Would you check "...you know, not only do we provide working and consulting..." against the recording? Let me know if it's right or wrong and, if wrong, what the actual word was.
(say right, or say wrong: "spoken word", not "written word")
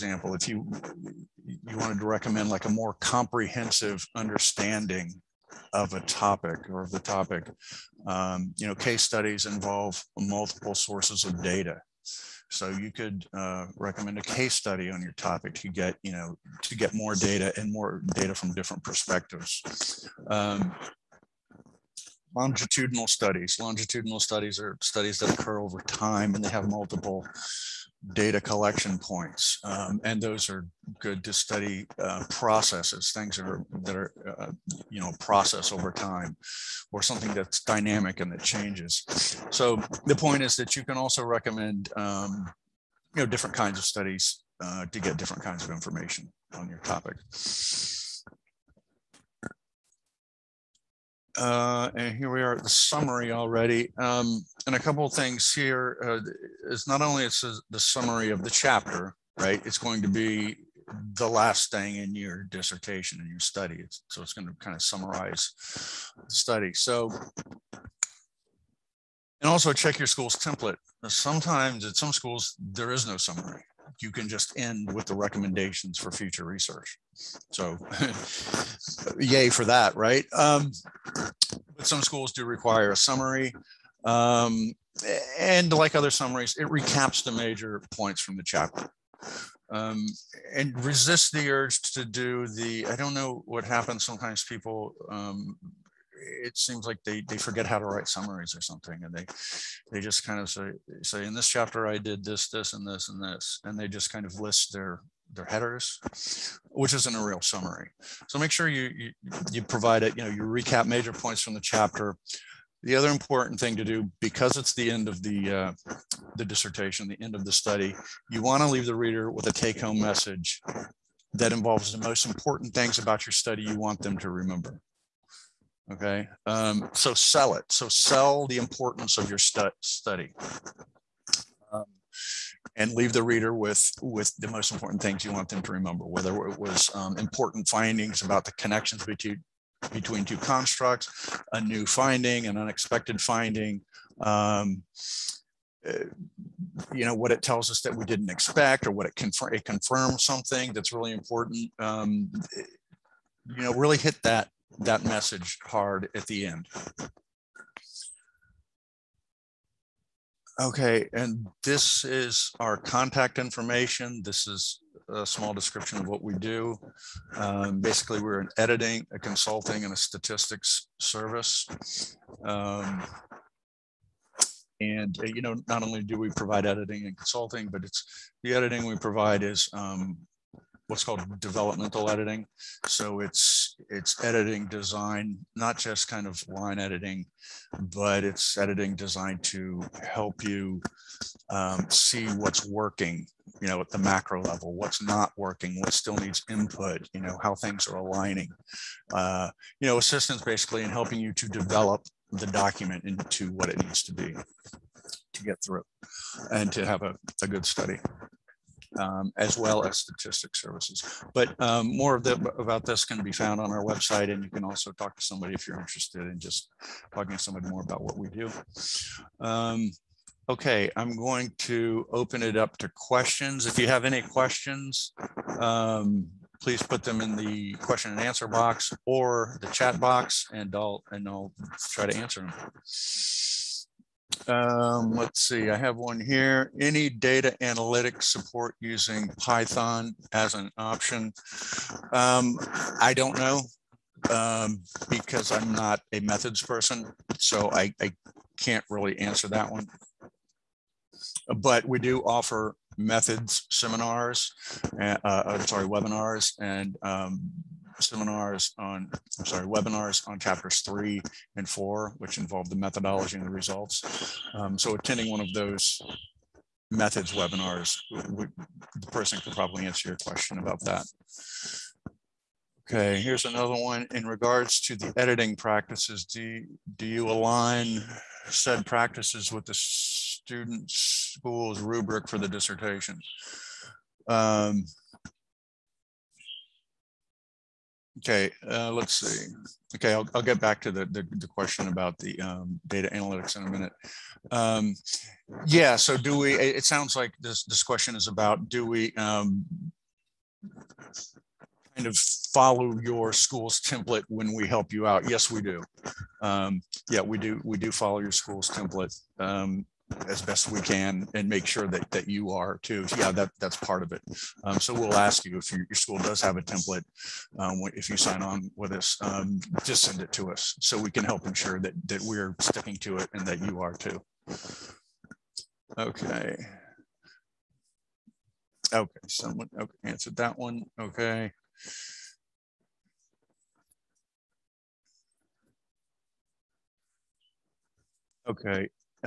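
wrong: "editing", not "working".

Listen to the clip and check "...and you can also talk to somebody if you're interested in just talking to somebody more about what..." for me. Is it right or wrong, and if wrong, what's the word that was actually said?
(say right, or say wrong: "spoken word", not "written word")
right.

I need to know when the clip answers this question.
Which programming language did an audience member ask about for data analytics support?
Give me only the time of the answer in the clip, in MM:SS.
03:59.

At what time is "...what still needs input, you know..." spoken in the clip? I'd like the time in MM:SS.
03:15.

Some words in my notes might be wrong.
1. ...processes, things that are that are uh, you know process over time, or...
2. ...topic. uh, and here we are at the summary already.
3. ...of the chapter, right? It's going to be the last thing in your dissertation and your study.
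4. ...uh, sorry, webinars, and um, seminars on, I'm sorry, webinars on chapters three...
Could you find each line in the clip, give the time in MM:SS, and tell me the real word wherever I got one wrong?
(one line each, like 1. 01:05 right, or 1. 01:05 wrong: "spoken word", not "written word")
1. 00:32 right
2. 00:46 right
3. 00:58 right
4. 04:15 right.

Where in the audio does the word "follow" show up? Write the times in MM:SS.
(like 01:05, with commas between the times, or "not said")
05:02, 05:07.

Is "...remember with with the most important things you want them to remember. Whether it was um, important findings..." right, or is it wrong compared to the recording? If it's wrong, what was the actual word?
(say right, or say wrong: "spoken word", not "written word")
wrong: "reader", not "remember".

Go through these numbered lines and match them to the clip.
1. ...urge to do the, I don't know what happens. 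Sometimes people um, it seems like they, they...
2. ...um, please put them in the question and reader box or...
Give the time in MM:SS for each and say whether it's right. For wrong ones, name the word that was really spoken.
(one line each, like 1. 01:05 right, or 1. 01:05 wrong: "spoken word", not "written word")
1. 01:31 right
2. 03:45 wrong: "answer", not "reader".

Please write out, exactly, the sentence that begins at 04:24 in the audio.
Um, so attending one of those methods webinars, we, the person could probably answer your question about that.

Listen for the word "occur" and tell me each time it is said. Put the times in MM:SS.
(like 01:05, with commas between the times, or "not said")
00:25.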